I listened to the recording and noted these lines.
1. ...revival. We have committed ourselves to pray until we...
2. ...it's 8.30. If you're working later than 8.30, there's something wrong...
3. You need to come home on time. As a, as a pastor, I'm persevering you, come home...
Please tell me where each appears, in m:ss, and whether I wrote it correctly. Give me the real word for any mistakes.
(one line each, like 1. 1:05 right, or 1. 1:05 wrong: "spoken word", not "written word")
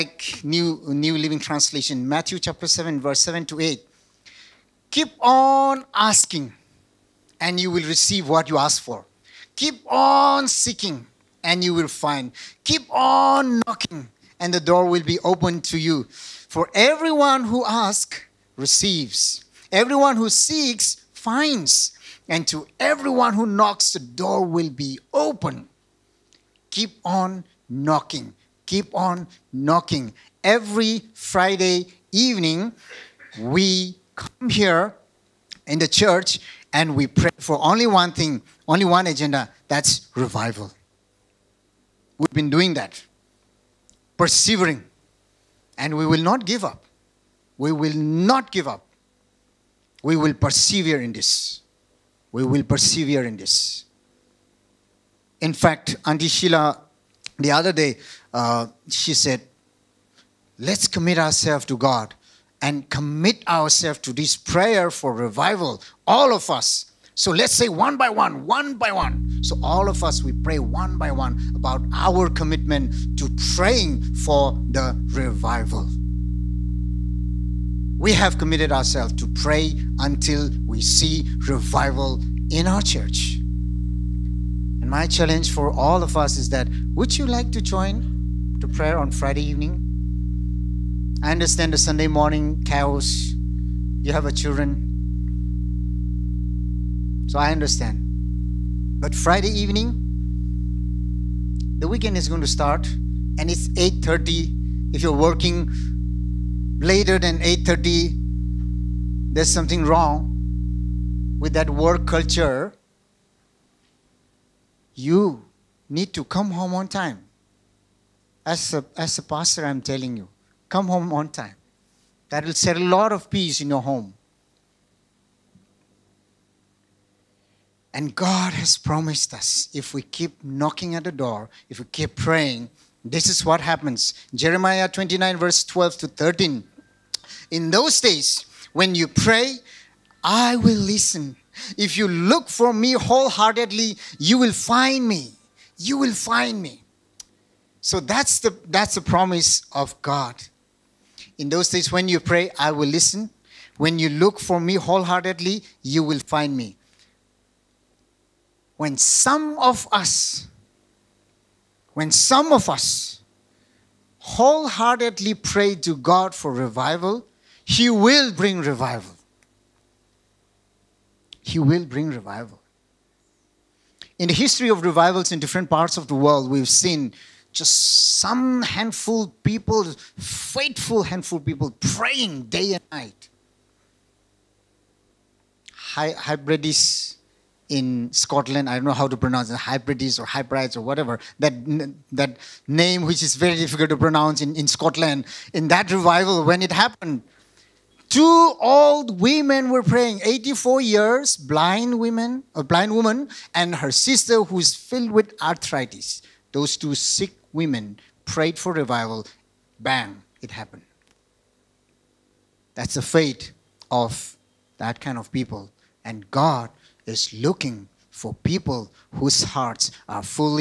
1. 1:15 right
2. 1:43 right
3. 1:54 wrong: "telling", not "persevering".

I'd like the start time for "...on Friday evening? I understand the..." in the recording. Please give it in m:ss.
1:28.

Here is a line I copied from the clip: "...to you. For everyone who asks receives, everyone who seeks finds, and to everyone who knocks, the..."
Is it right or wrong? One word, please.
right.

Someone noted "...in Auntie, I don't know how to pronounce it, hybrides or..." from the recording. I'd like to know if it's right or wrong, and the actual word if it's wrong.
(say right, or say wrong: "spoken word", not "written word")
wrong: "Scotland", not "Auntie".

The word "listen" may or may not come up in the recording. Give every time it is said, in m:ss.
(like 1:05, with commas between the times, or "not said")
2:20, 2:32.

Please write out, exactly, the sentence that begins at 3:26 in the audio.
Those two sick women prayed for revival.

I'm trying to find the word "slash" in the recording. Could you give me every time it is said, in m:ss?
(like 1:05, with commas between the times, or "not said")
not said.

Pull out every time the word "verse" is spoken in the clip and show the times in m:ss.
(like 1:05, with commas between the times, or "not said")
0:02, 2:15.